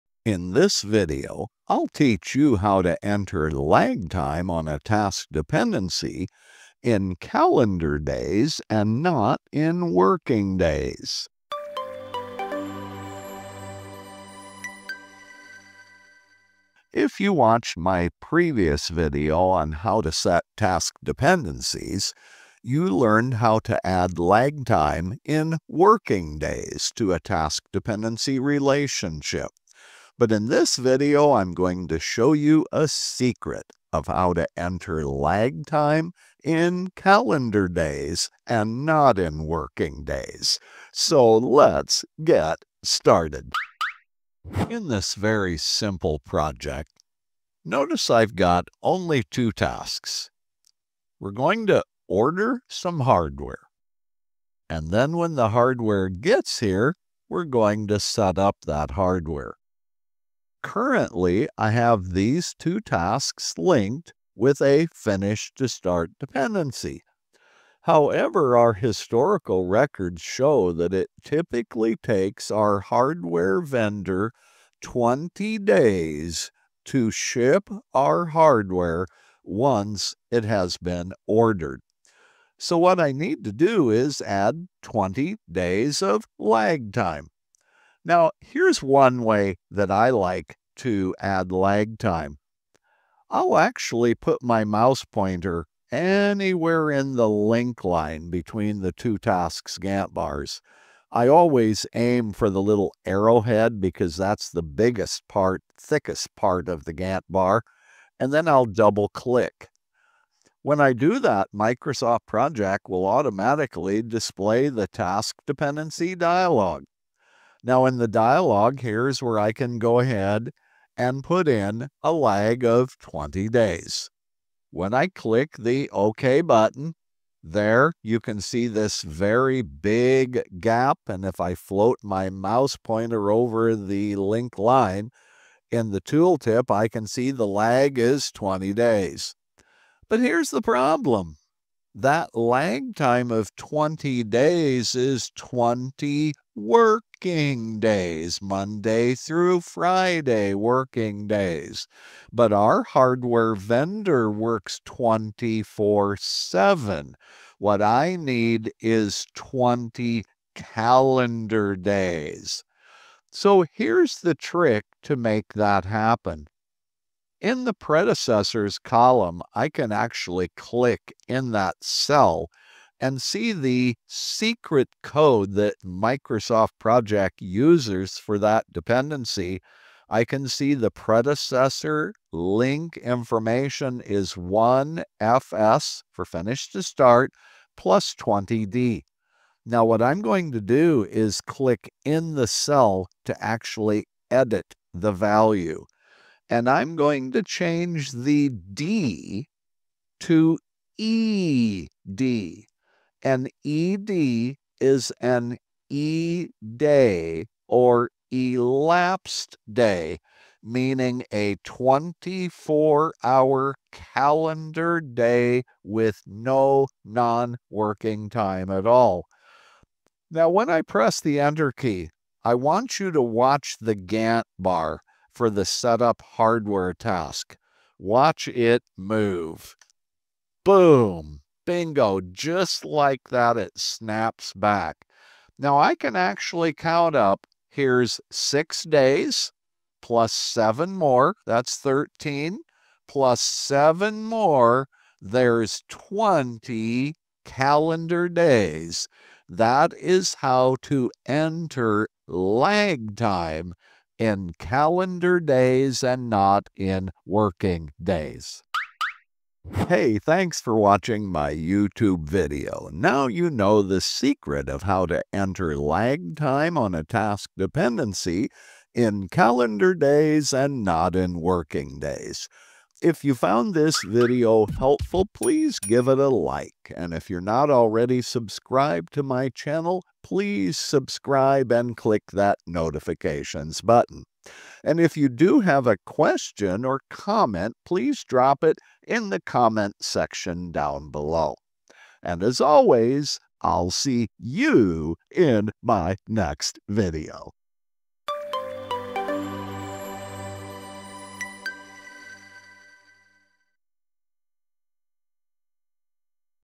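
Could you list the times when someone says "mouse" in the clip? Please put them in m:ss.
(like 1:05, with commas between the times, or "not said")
1:34, 2:12.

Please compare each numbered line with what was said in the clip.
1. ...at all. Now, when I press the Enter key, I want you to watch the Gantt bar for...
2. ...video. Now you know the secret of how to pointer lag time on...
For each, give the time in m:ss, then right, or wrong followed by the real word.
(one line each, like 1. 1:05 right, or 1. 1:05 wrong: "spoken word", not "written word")
1. 3:38 right
2. 4:22 wrong: "enter", not "pointer".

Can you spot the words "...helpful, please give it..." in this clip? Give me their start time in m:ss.
4:34.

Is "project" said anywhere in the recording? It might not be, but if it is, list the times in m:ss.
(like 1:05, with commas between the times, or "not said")
0:46, 1:52, 2:56.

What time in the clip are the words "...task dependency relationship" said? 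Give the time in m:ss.
0:27.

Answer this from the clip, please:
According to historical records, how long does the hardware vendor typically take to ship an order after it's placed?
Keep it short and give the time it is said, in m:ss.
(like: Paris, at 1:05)
20 days, at 1:14.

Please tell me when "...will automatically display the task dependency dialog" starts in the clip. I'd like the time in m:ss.
1:52.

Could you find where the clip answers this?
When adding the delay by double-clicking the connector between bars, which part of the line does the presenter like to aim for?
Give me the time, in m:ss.
1:42.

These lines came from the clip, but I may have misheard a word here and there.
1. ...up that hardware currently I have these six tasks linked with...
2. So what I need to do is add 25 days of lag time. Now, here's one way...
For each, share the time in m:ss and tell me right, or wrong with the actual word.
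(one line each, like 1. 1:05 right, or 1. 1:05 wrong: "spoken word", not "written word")
1. 0:58 wrong: "two", not "six"
2. 1:22 wrong: "20", not "25".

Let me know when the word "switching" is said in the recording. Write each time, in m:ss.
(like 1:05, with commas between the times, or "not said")
not said.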